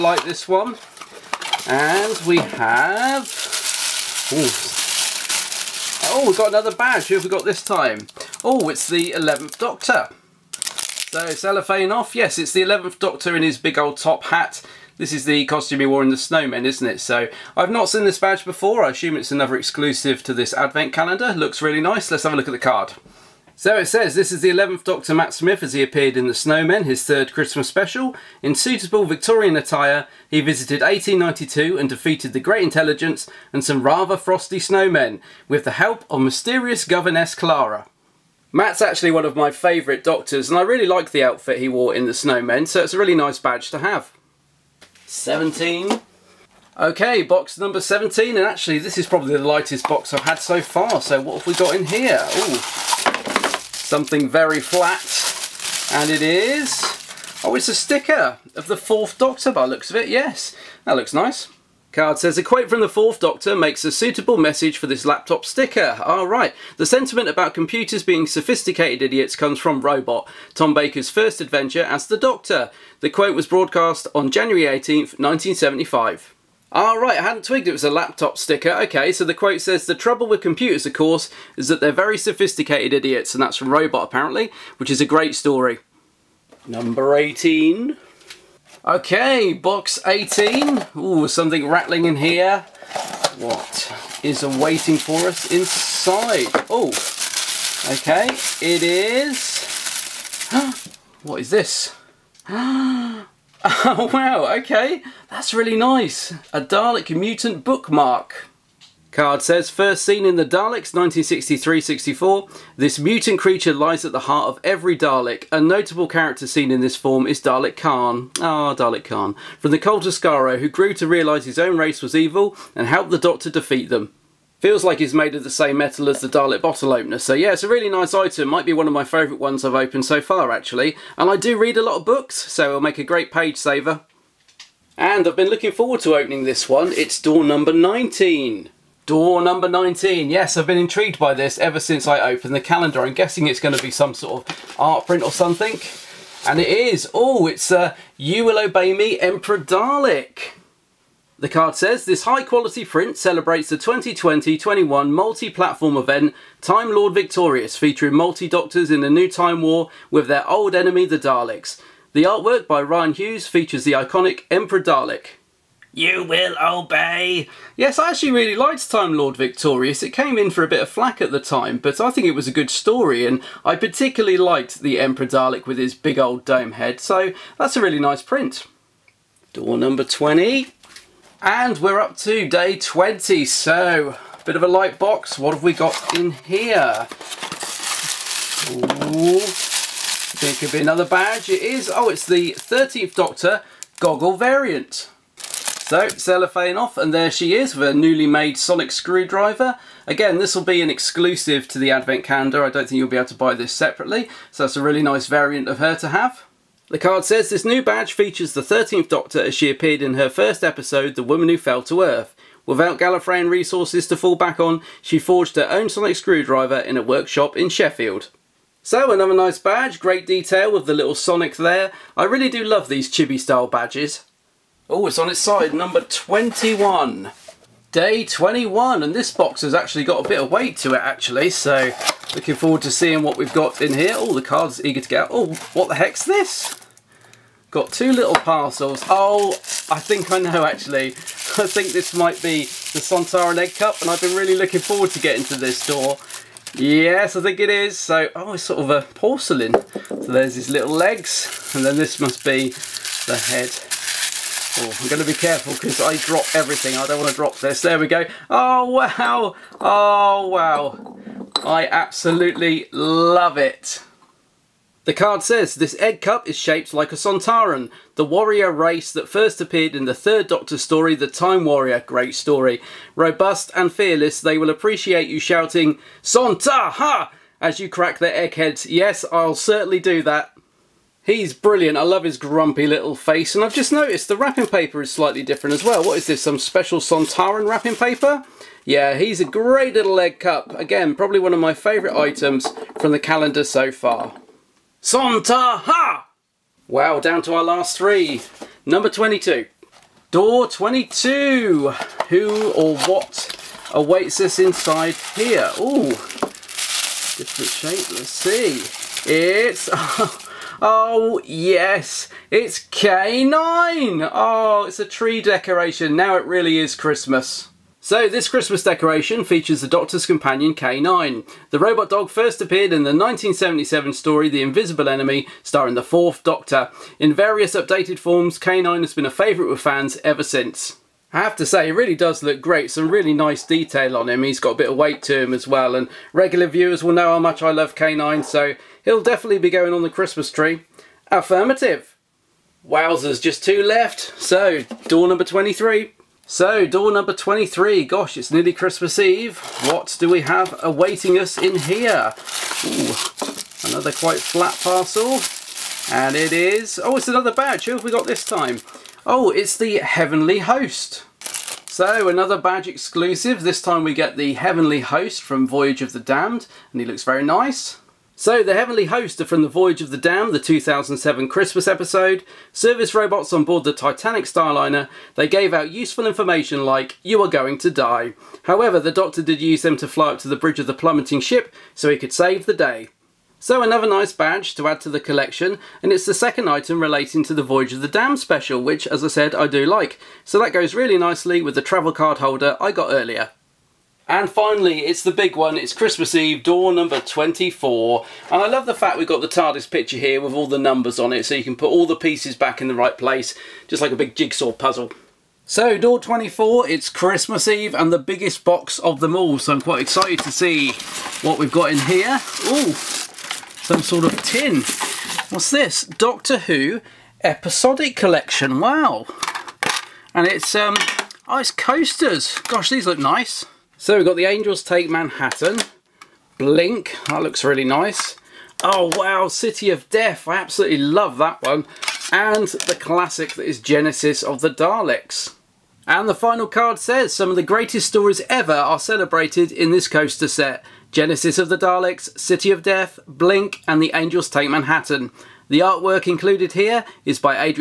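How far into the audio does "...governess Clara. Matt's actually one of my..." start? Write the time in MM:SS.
00:36.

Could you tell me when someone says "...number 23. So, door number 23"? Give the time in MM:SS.
05:45.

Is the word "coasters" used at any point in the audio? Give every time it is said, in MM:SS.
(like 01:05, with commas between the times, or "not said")
07:01, 07:20.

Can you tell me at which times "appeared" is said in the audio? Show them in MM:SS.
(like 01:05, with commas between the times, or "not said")
00:25, 03:29, 04:29, 05:22.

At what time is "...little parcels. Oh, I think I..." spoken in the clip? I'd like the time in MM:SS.
03:58.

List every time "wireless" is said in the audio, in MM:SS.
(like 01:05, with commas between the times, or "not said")
not said.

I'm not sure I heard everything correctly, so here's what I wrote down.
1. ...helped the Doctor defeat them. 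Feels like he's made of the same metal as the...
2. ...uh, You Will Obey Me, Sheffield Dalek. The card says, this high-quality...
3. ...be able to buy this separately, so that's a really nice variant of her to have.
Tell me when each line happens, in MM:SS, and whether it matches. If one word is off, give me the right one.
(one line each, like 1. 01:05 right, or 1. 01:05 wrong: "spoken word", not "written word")
1. 02:02 right
2. 02:27 wrong: "Emperor", not "Sheffield"
3. 03:23 right.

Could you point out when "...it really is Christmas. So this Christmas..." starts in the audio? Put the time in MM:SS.
05:16.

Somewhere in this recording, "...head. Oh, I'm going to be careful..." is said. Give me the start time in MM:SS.
04:13.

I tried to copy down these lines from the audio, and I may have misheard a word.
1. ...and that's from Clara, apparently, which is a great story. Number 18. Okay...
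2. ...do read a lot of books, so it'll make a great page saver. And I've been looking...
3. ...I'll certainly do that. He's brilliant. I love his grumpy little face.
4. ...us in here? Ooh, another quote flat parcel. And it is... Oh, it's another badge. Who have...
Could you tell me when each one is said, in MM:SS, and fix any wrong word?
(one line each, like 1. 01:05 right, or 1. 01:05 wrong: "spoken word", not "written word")
1. 01:23 wrong: "Robot", not "Clara"
2. 02:11 right
3. 04:39 right
4. 05:51 wrong: "quite", not "quote".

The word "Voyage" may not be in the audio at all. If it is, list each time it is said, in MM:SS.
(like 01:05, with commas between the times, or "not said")
06:05, 06:09, 06:27.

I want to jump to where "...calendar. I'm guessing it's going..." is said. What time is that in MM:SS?
02:22.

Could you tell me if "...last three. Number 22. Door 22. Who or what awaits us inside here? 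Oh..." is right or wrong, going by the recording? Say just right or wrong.
right.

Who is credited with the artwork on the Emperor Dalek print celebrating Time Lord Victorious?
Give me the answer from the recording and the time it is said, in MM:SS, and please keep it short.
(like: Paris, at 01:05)
Ryan Hughes, at 02:42.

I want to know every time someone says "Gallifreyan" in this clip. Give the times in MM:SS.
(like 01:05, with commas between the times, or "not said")
03:32.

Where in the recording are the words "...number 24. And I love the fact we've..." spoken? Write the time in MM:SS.
06:36.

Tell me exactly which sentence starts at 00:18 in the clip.
I assume it's another exclusive to this advent calendar.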